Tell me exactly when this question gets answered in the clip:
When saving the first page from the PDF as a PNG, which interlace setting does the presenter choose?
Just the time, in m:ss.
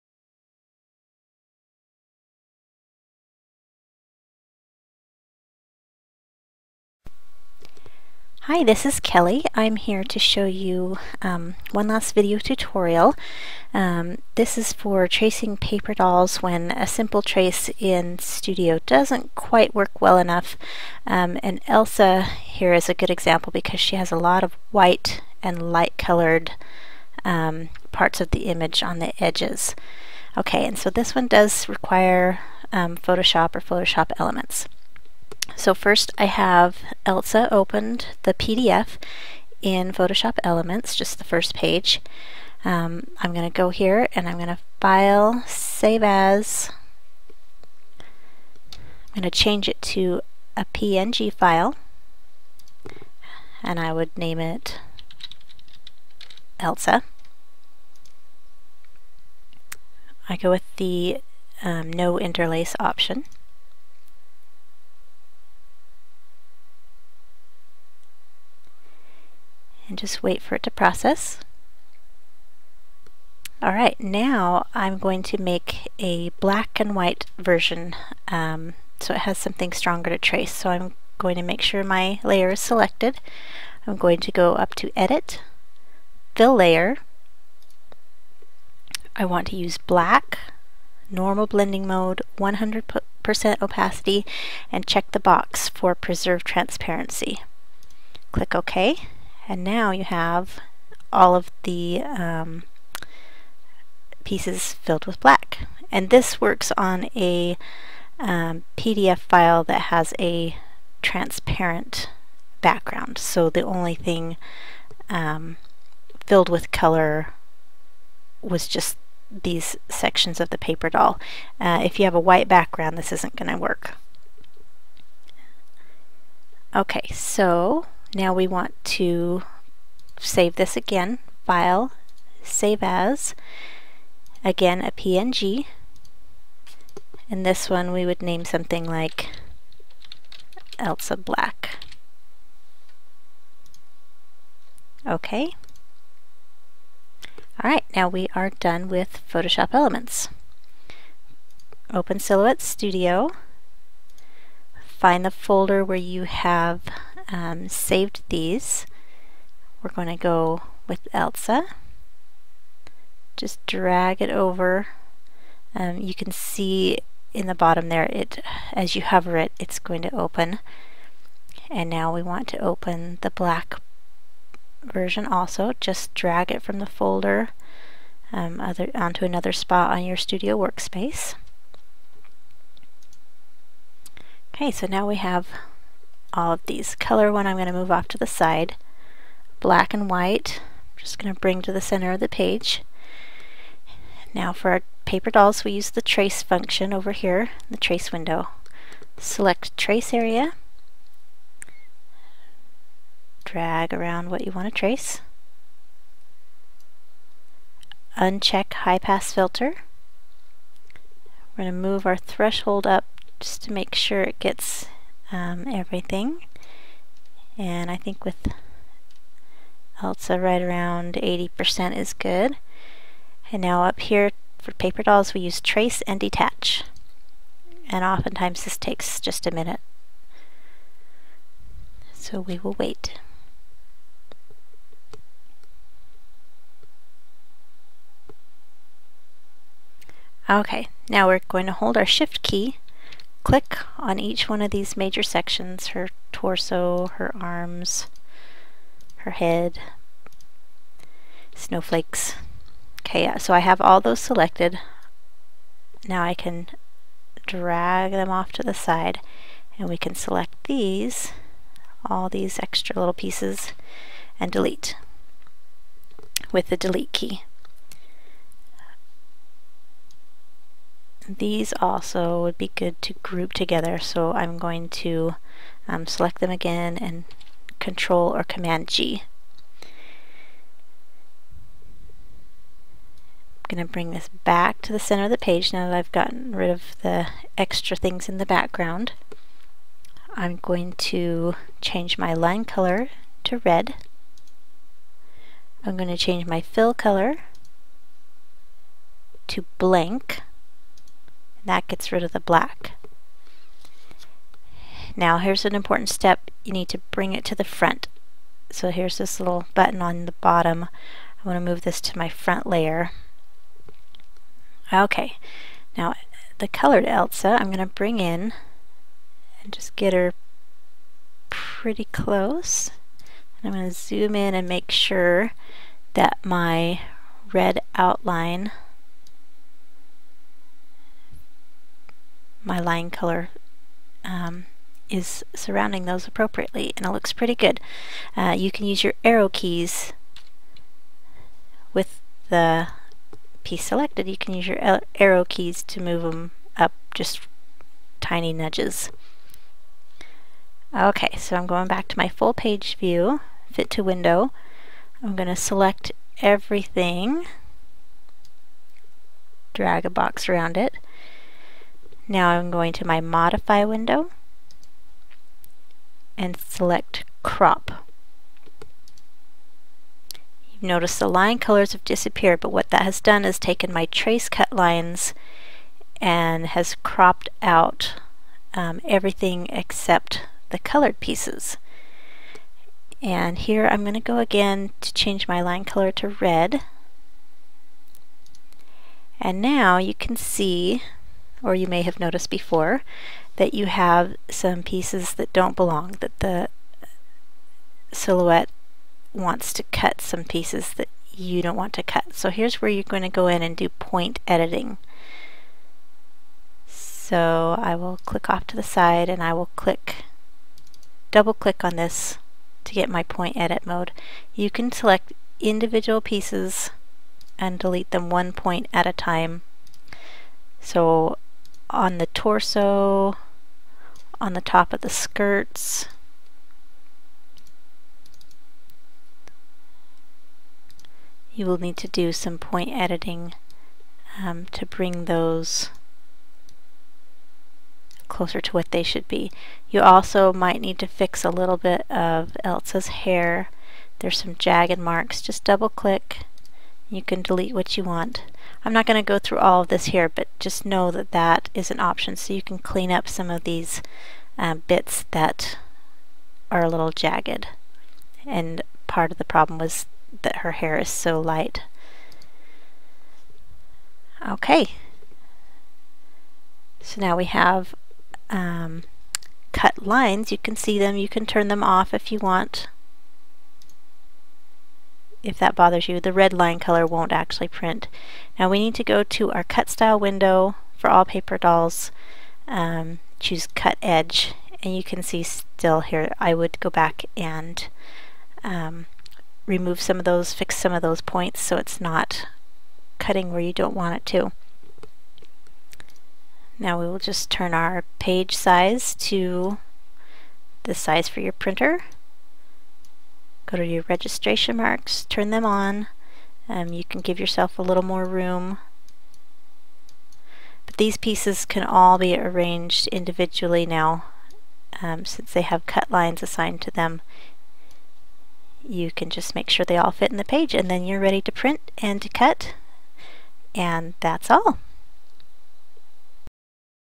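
1:01.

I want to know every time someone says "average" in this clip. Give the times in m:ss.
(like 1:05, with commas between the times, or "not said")
not said.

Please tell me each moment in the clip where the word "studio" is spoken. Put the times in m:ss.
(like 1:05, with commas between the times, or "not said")
0:18, 2:32, 3:00.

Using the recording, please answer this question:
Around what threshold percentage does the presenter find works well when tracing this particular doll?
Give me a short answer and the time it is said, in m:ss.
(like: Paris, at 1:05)
80%, at 3:41.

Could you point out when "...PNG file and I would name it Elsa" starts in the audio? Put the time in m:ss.
0:50.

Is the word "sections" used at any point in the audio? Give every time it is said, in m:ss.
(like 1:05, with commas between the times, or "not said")
1:59, 4:05.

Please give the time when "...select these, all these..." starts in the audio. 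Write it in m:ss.
4:20.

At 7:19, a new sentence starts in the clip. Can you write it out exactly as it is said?
You also might need to fix a little bit of Elsa's hair.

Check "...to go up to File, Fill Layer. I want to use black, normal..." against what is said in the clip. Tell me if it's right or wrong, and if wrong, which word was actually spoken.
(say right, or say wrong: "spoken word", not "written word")
wrong: "Edit", not "File".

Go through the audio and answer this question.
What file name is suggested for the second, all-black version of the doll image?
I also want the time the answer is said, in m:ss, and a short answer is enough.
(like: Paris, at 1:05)
Elsa Black, at 2:20.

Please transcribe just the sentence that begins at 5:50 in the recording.
Okay, so I'm going back to my full page view, fit to window.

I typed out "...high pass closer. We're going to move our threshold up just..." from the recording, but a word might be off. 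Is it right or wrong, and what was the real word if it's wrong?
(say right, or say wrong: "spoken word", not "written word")
wrong: "filter", not "closer".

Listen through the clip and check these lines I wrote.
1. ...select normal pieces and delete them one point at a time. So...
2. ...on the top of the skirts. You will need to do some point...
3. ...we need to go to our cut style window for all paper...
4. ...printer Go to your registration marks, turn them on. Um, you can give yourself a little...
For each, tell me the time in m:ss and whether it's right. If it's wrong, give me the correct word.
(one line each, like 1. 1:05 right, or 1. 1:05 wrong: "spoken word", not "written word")
1. 6:54 wrong: "individual", not "normal"
2. 7:04 right
3. 7:58 right
4. 8:21 right.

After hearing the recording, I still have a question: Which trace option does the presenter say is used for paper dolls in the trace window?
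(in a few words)
Trace and detach.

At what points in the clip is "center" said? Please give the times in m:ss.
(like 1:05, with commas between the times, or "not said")
3:11, 4:44.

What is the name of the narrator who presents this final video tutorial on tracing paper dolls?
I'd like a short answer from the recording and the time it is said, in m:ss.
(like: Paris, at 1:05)
Kelly, at 0:08.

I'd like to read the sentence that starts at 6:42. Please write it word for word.
So here's where you're going to go in and do point editing.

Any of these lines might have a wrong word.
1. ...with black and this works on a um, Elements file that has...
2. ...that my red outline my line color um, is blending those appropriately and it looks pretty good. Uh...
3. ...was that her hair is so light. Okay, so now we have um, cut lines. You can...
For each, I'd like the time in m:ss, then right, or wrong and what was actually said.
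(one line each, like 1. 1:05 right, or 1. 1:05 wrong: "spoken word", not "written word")
1. 1:45 wrong: "PDF", not "Elements"
2. 5:26 wrong: "surrounding", not "blending"
3. 7:39 right.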